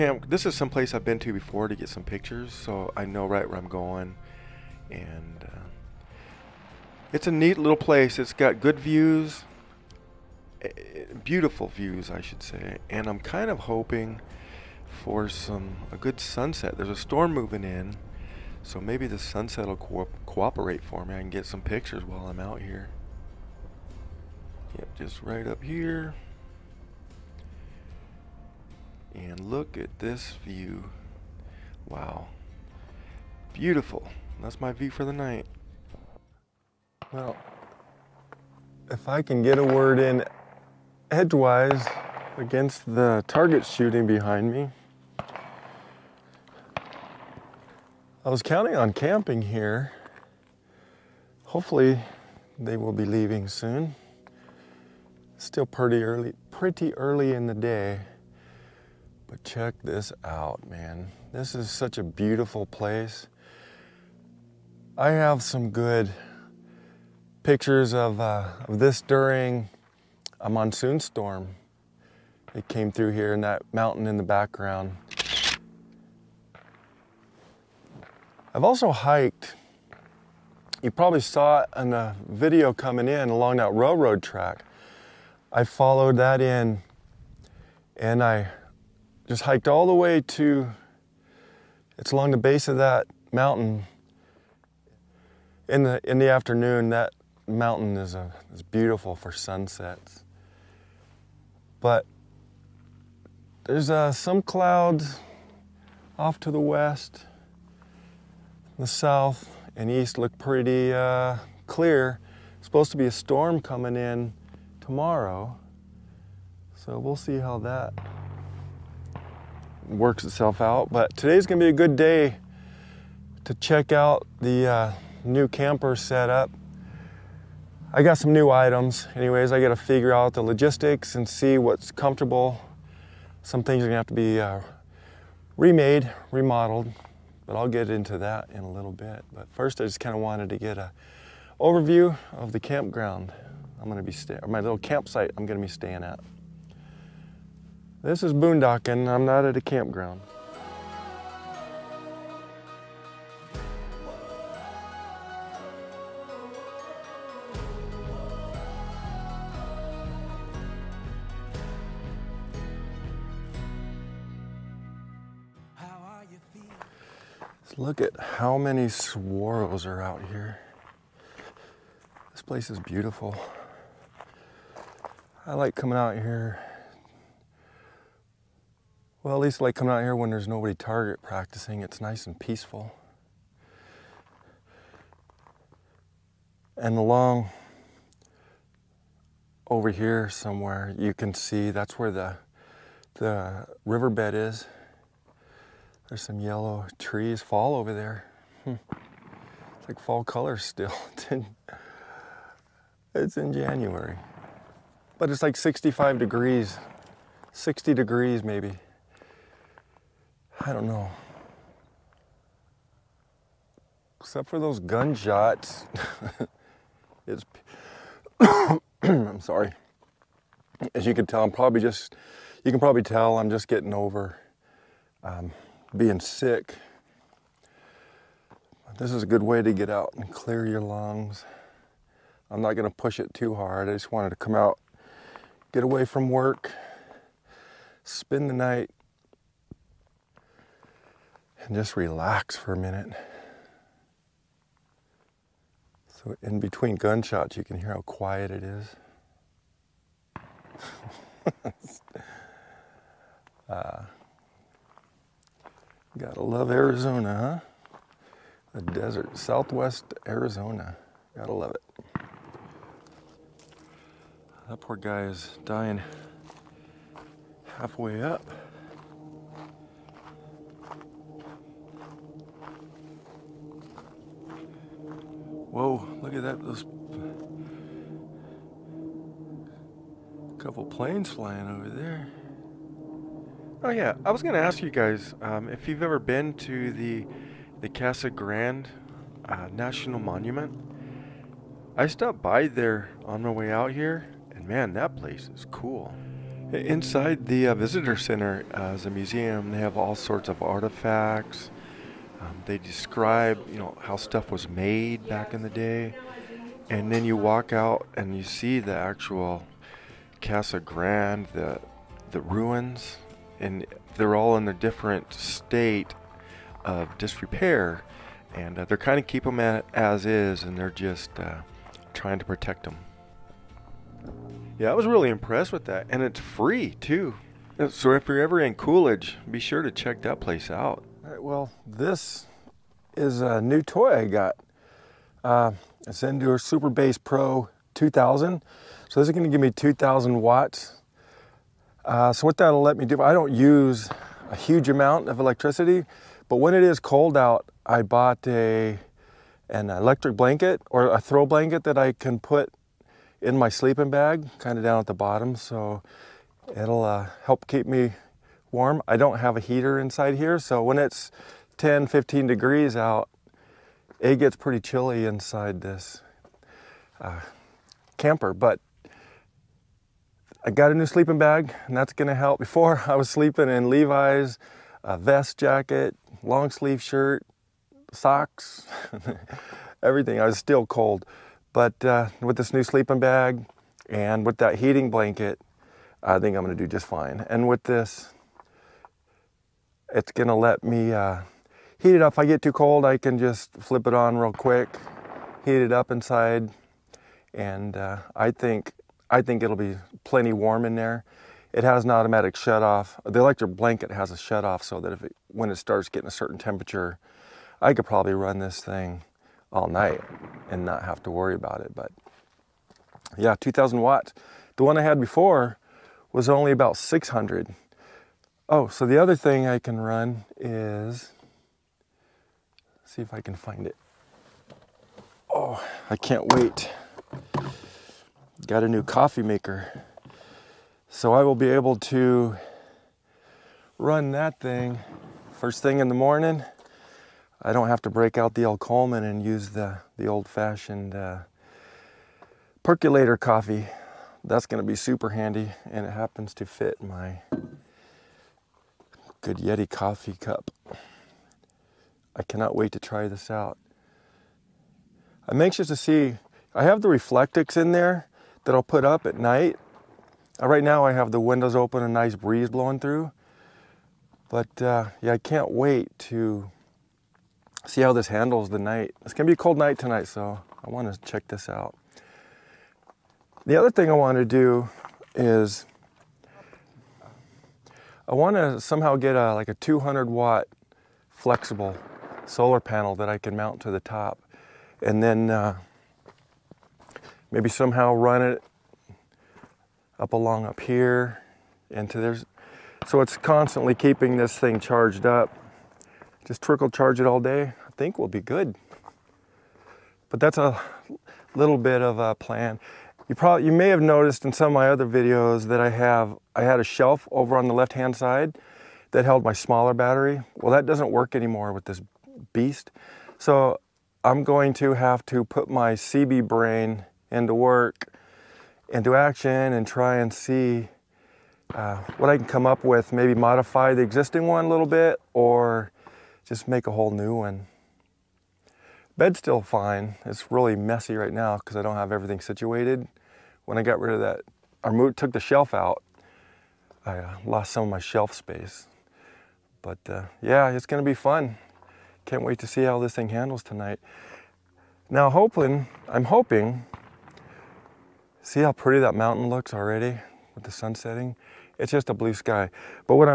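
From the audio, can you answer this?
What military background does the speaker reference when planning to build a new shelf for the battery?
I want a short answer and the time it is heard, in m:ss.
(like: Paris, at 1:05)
Seabee, at 8:35.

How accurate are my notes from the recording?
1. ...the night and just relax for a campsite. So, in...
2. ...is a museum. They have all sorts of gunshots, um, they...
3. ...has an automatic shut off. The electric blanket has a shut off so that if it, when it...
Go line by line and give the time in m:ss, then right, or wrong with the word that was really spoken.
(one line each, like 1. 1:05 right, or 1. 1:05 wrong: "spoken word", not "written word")
1. 3:58 wrong: "minute", not "campsite"
2. 4:58 wrong: "artifacts", not "gunshots"
3. 6:41 right.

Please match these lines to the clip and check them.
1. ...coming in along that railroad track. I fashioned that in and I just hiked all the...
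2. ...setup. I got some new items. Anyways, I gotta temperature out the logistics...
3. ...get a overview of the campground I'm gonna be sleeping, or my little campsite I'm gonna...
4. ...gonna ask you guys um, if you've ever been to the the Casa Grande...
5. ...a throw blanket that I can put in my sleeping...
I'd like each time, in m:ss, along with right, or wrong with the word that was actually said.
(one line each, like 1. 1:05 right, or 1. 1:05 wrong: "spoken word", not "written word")
1. 1:22 wrong: "followed", not "fashioned"
2. 2:05 wrong: "figure", not "temperature"
3. 2:20 wrong: "staying", not "sleeping"
4. 4:44 right
5. 5:51 right.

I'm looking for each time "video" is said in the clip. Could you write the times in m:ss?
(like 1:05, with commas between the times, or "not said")
1:22, 8:25.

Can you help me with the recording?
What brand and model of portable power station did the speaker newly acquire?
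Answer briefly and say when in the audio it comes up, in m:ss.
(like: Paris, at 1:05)
Zendure SuperBase Pro 2000, at 5:36.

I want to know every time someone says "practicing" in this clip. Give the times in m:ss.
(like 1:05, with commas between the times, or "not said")
3:01.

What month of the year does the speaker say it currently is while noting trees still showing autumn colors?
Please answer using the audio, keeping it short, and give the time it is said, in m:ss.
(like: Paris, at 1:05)
January, at 3:23.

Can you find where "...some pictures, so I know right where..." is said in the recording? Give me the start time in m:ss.
0:01.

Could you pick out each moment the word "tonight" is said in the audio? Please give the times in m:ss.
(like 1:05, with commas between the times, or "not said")
7:49, 9:03.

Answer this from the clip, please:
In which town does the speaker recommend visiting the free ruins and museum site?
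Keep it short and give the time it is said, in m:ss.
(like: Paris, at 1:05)
Coolidge, at 5:28.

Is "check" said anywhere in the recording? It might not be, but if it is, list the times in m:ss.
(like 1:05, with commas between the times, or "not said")
0:59, 2:03, 5:29, 7:51.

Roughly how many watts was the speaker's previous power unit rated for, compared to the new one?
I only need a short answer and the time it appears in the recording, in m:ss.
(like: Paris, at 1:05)
600, at 6:56.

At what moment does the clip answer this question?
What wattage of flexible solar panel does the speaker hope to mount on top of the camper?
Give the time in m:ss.
7:59.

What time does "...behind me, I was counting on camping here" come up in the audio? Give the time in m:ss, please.
0:44.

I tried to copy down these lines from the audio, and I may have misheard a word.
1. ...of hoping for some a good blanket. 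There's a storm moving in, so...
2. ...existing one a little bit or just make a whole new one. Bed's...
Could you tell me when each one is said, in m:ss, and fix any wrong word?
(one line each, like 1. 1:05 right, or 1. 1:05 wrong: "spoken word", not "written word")
1. 0:13 wrong: "sunset", not "blanket"
2. 8:44 right.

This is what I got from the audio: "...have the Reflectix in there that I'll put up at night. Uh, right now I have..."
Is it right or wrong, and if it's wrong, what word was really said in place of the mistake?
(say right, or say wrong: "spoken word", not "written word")
right.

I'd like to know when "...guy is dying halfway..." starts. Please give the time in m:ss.
4:24.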